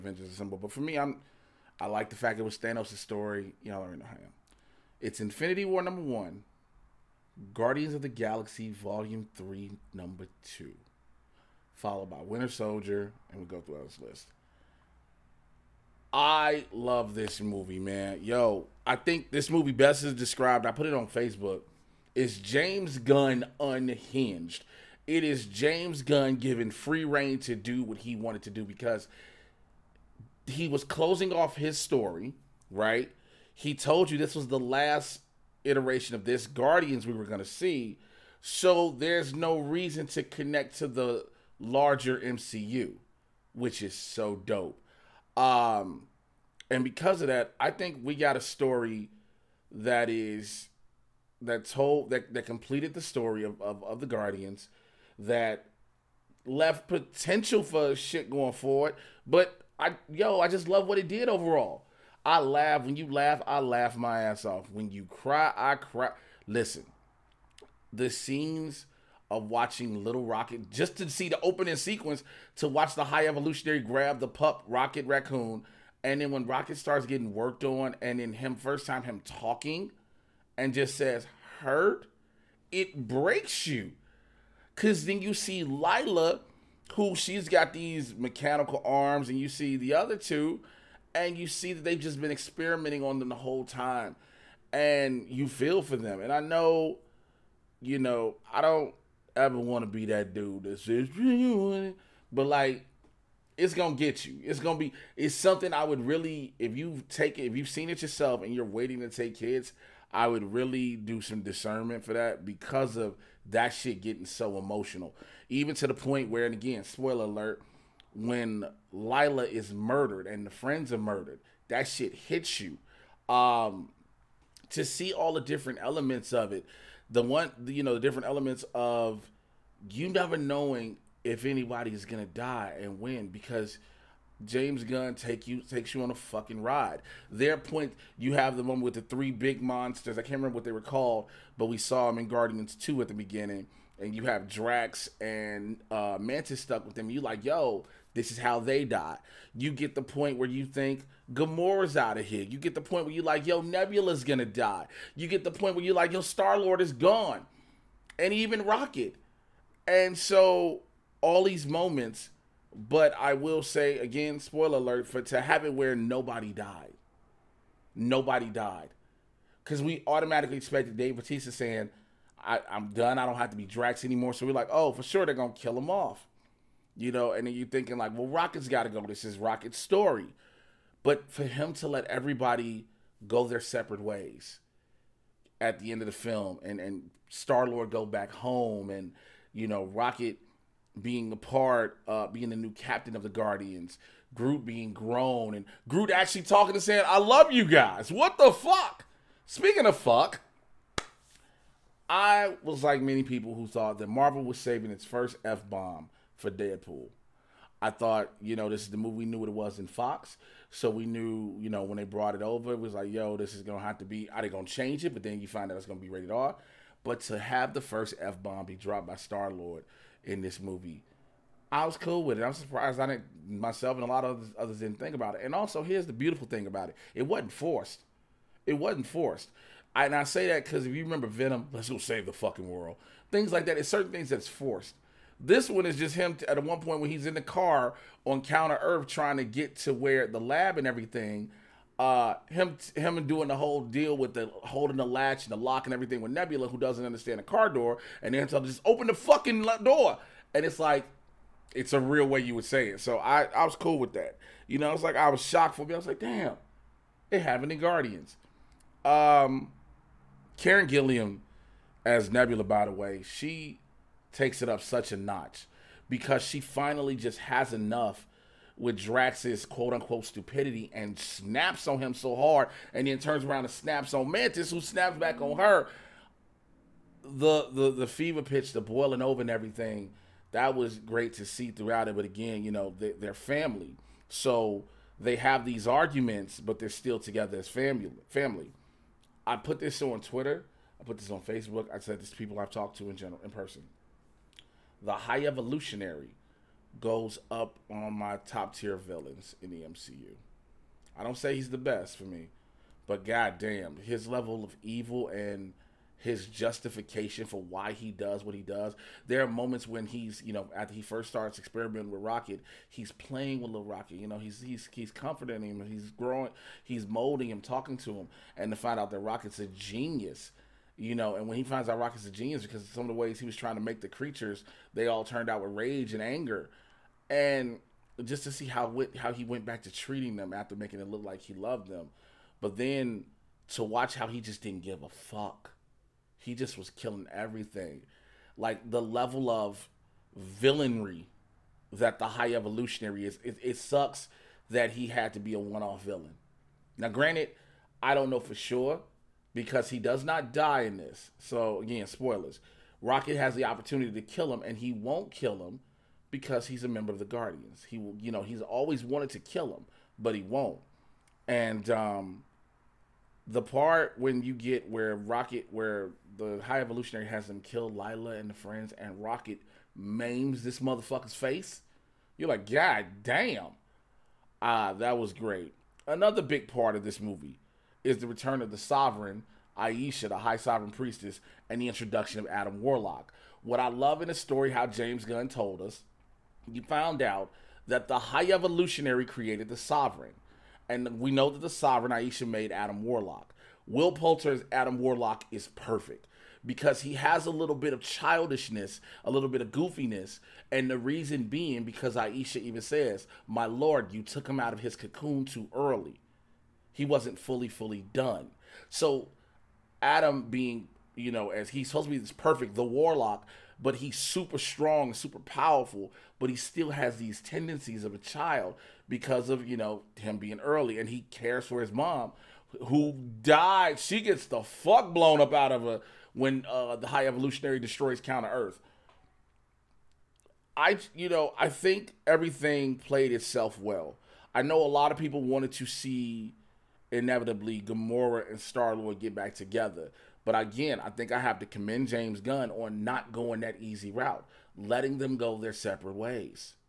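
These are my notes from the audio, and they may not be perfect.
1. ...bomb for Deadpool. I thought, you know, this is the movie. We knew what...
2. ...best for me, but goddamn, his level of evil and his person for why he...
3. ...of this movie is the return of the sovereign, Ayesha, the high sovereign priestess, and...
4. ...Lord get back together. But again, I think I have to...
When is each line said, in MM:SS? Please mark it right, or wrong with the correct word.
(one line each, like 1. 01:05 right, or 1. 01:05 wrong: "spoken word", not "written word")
1. 03:25 right
2. 05:01 wrong: "justification", not "person"
3. 06:16 right
4. 07:18 right.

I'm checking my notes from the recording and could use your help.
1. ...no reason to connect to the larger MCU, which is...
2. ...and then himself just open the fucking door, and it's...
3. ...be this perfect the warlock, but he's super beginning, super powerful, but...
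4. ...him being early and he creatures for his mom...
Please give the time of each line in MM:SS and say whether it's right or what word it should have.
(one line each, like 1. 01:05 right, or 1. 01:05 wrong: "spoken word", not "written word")
1. 00:39 right
2. 04:08 right
3. 06:52 wrong: "strong", not "beginning"
4. 07:00 wrong: "cares", not "creatures".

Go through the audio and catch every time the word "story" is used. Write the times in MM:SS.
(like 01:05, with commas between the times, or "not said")
00:02, 00:31, 00:48, 00:53, 02:59, 06:24.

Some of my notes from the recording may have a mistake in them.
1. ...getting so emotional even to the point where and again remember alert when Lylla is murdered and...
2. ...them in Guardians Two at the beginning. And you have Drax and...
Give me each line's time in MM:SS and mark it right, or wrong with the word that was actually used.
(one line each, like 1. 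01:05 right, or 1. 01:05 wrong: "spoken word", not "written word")
1. 01:54 wrong: "spoiler", not "remember"
2. 02:22 right.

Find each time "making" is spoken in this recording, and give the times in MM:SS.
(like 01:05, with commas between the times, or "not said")
05:30.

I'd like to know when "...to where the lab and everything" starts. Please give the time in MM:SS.
03:59.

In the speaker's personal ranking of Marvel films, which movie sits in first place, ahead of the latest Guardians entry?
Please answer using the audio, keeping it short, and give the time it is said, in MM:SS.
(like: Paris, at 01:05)
Infinity War, at 00:05.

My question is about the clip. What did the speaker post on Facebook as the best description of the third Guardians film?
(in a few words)
James Gunn unhinged.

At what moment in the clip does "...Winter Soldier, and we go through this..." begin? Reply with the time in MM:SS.
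00:12.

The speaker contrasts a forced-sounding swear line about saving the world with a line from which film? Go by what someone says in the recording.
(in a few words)
Venom.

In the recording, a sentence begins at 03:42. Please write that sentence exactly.
I'm surprised I didn't myself and a lot of others, didn't think about it.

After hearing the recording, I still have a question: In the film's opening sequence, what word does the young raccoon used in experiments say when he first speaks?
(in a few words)
Hurt.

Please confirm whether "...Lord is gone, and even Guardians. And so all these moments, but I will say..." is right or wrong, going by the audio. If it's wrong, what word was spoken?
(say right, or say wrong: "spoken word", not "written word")
wrong: "Rocket", not "Guardians".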